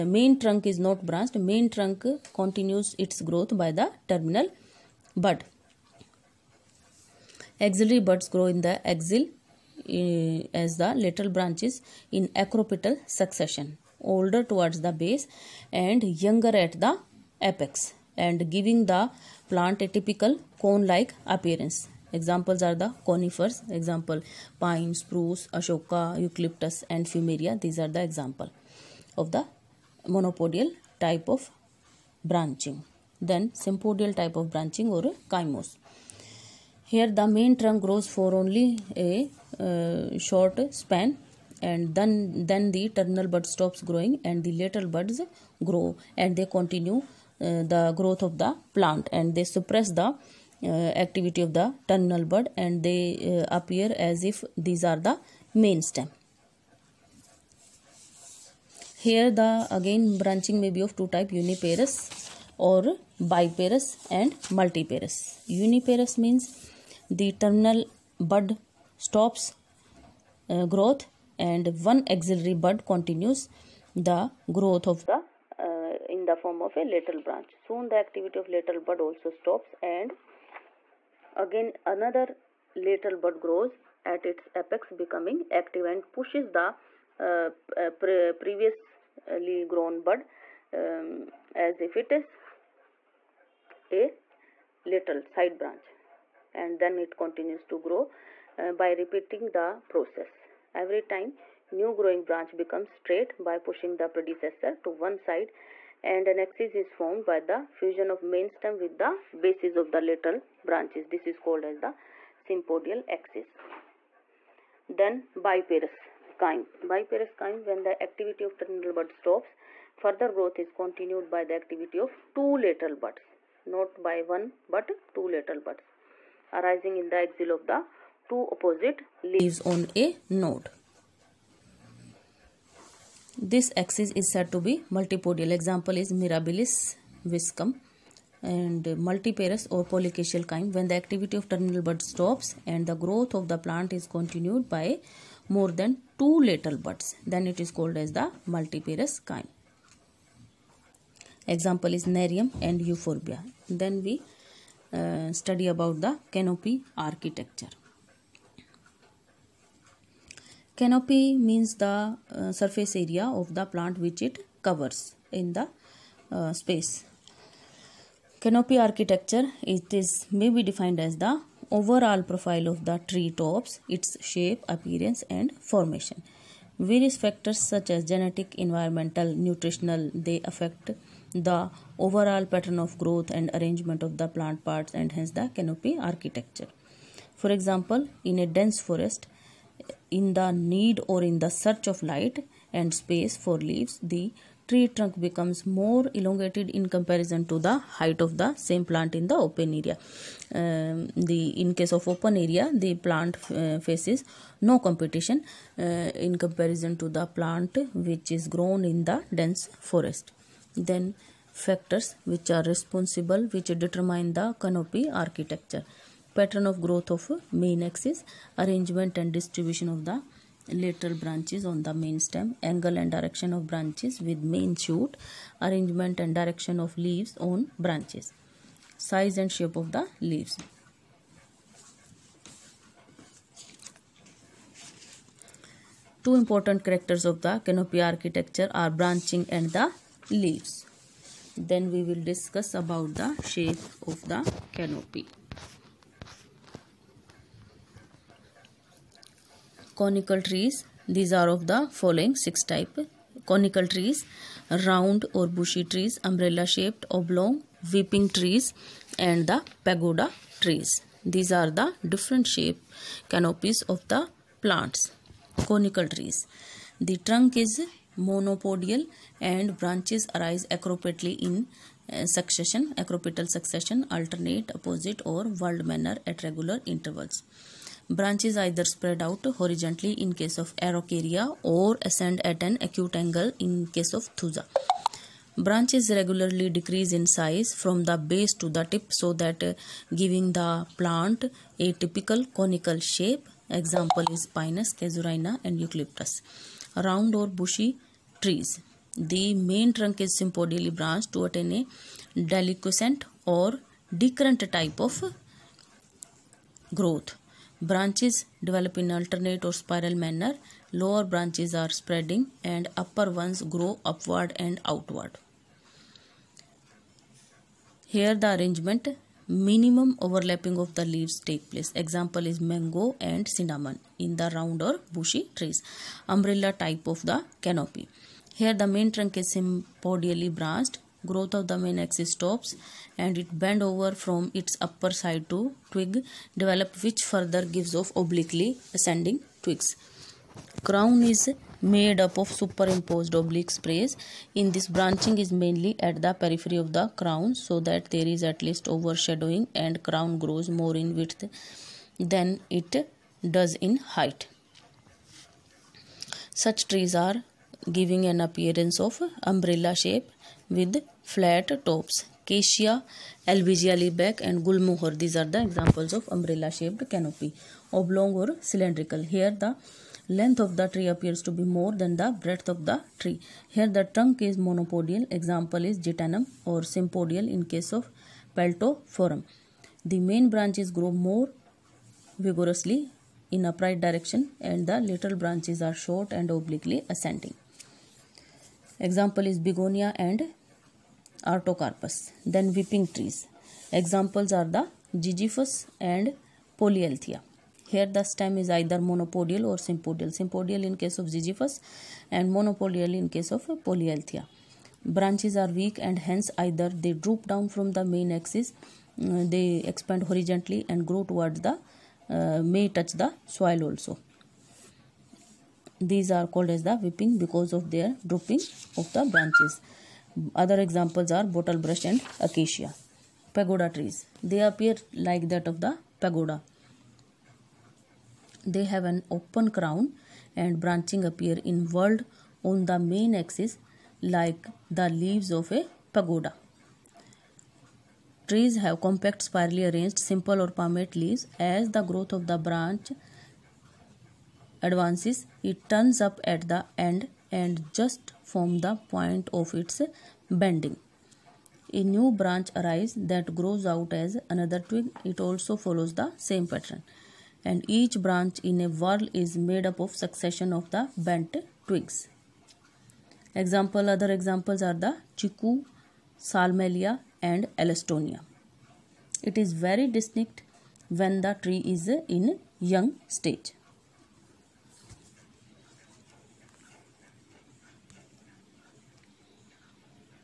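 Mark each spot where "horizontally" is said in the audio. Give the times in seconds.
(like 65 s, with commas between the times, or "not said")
279 s, 410 s.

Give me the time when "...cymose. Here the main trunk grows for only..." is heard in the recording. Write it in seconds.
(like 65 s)
35 s.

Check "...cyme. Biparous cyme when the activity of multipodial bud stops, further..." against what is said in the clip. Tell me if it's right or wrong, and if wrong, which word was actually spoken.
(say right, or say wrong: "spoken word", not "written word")
wrong: "terminal", not "multipodial".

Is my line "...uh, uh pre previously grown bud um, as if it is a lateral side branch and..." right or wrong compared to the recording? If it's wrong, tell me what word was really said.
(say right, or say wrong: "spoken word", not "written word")
right.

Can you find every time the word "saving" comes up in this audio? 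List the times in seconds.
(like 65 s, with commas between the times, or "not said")
not said.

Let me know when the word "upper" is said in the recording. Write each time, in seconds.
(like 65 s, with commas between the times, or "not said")
312 s, 334 s.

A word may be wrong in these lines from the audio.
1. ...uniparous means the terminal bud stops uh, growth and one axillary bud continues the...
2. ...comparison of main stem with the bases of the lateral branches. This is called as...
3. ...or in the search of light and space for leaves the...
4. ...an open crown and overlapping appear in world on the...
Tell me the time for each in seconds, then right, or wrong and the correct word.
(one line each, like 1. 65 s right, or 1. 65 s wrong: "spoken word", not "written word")
1. 65 s right
2. 107 s wrong: "fusion", not "comparison"
3. 191 s right
4. 429 s wrong: "branching", not "overlapping".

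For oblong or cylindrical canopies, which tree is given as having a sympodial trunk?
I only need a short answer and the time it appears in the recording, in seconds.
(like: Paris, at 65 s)
Peltophorum, at 378 s.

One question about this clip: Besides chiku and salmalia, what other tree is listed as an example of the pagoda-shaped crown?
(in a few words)
Alstonia.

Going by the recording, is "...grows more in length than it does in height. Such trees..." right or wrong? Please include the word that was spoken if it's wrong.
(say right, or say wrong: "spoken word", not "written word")
wrong: "width", not "length".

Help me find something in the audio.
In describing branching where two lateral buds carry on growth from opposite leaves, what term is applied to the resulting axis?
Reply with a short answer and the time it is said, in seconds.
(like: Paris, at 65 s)
Multipodial, at 134 s.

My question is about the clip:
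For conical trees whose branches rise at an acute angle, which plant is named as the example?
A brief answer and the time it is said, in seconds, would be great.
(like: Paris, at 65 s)
Thuja, at 284 s.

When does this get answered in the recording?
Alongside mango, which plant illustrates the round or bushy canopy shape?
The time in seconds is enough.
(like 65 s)
323 s.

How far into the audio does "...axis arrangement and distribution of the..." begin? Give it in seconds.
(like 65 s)
217 s.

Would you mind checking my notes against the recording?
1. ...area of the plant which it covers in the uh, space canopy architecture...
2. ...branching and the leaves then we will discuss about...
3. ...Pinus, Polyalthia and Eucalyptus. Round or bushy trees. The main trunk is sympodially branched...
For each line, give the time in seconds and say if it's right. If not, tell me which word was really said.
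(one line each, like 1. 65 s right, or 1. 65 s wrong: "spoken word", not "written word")
1. 163 s right
2. 239 s right
3. 294 s wrong: "Casuarina", not "Polyalthia".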